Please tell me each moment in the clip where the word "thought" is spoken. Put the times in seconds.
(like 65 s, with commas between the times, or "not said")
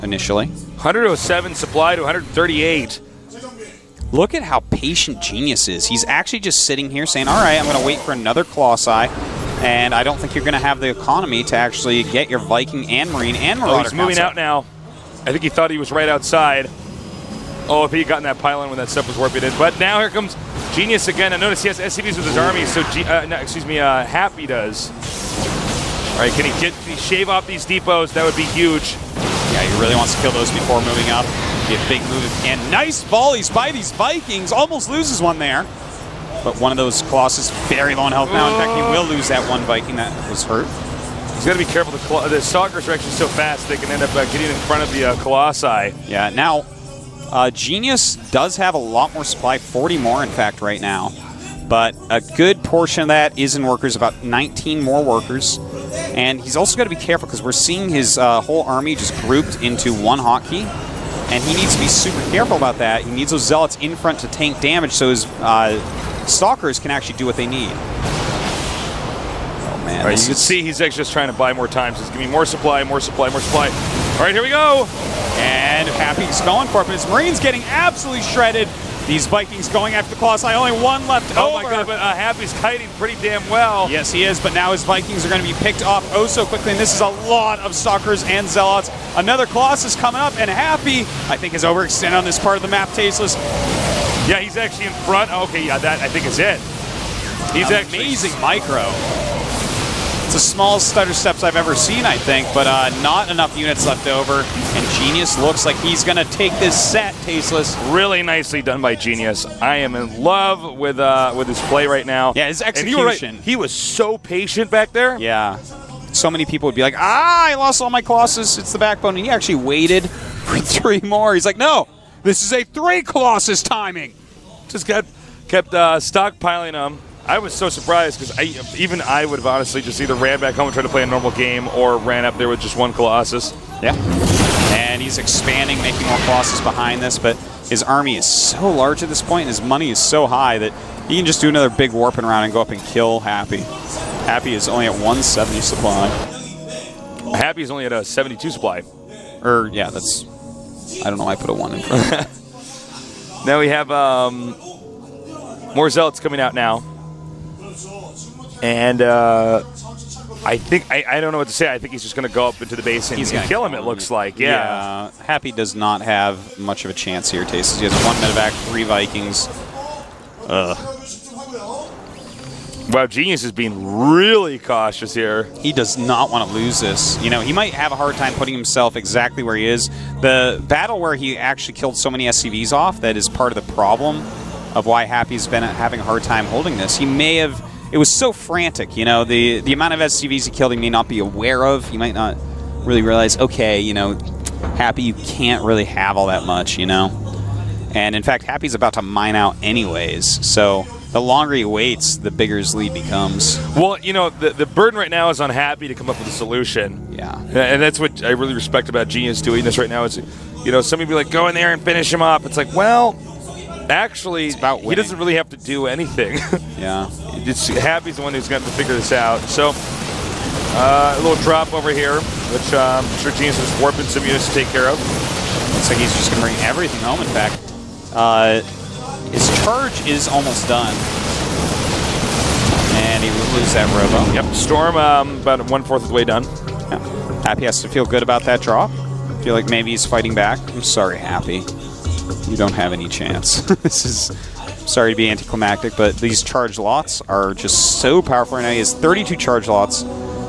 15 s.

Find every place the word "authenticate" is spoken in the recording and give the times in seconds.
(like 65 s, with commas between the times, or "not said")
not said.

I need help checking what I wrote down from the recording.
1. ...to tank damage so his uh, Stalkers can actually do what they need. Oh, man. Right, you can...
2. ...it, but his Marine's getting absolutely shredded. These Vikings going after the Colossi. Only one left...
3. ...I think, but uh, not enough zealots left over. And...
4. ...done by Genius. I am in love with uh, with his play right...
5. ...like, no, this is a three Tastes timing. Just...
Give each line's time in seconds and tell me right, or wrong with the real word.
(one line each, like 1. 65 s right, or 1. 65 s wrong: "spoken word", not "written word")
1. 64 s right
2. 76 s right
3. 102 s wrong: "units", not "zealots"
4. 108 s right
5. 121 s wrong: "Colossus", not "Tastes".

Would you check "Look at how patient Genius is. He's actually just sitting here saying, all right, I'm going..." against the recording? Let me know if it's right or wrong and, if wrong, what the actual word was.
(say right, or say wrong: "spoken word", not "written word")
right.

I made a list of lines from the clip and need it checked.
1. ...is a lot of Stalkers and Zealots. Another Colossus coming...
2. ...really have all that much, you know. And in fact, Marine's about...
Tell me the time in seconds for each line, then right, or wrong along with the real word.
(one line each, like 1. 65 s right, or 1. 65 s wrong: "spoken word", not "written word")
1. 86 s right
2. 195 s wrong: "Happy", not "Marine".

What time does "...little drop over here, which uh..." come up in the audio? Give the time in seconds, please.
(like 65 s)
221 s.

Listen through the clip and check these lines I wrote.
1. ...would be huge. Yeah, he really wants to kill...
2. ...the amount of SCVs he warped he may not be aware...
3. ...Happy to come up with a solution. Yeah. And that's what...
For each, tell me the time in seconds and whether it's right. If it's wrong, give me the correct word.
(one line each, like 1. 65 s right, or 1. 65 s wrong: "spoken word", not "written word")
1. 28 s right
2. 189 s wrong: "killed", not "warped"
3. 205 s right.